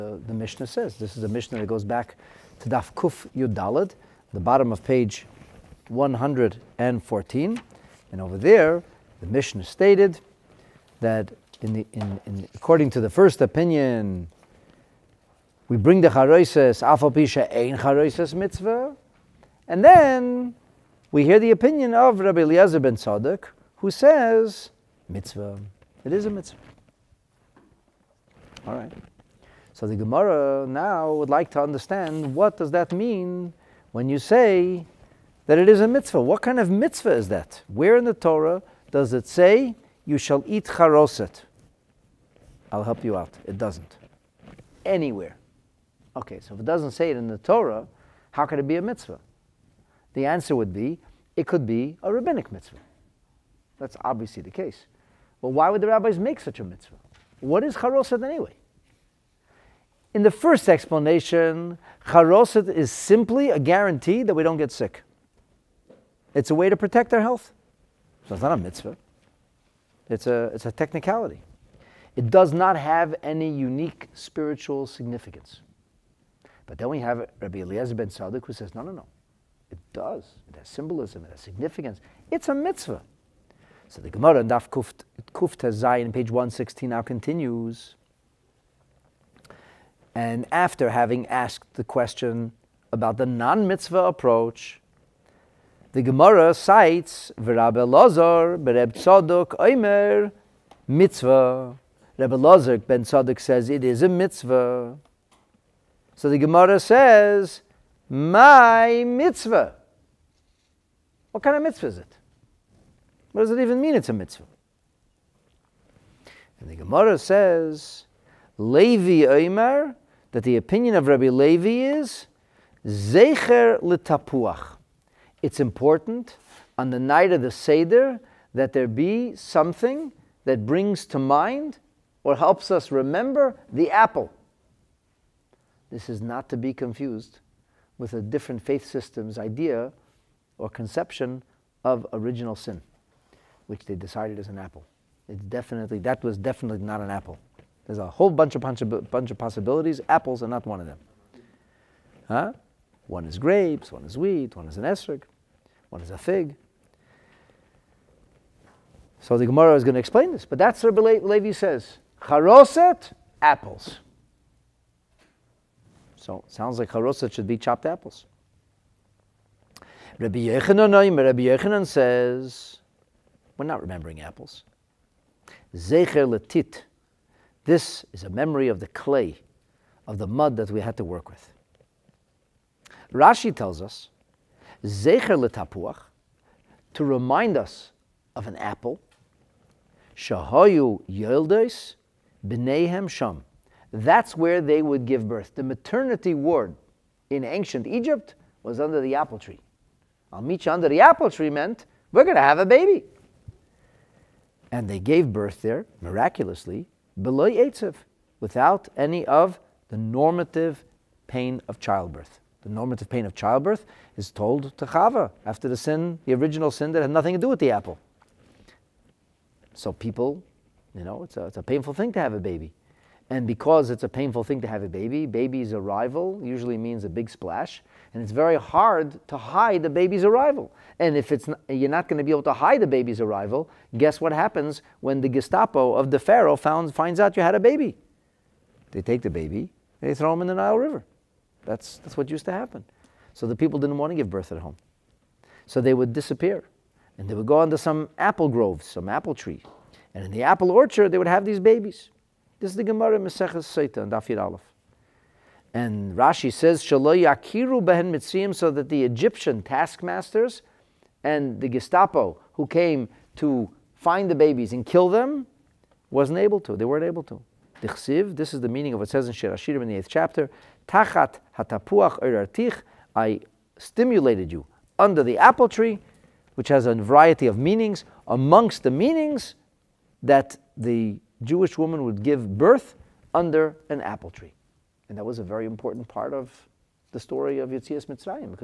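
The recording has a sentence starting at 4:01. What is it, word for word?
That's, that's what used to happen.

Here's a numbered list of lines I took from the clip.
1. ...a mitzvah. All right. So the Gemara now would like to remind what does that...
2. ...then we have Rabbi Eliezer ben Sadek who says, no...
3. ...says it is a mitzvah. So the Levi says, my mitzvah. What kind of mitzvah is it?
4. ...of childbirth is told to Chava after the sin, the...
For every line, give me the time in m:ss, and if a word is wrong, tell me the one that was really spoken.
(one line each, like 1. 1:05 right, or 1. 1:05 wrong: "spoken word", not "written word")
1. 0:26 wrong: "understand", not "remind"
2. 1:16 right
3. 1:43 wrong: "Gemara", not "Levi"
4. 3:33 right.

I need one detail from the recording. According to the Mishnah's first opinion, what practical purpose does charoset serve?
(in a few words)
Protect our health.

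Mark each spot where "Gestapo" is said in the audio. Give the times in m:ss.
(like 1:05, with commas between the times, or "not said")
3:55, 4:21.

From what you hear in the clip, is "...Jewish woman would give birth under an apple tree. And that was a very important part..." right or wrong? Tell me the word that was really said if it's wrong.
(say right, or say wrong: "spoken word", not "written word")
right.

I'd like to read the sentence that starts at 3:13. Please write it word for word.
That's where they would give birth.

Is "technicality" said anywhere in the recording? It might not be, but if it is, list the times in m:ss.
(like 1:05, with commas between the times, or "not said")
1:10.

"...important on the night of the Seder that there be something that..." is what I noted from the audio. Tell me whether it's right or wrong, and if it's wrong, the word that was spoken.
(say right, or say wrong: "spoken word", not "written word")
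right.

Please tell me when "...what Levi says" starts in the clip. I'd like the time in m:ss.
2:40.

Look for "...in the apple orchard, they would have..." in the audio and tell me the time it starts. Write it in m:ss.
4:10.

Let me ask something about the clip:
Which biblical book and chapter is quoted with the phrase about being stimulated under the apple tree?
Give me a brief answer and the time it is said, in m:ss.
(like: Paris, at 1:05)
Shir Hashirim, chapter 8, at 4:29.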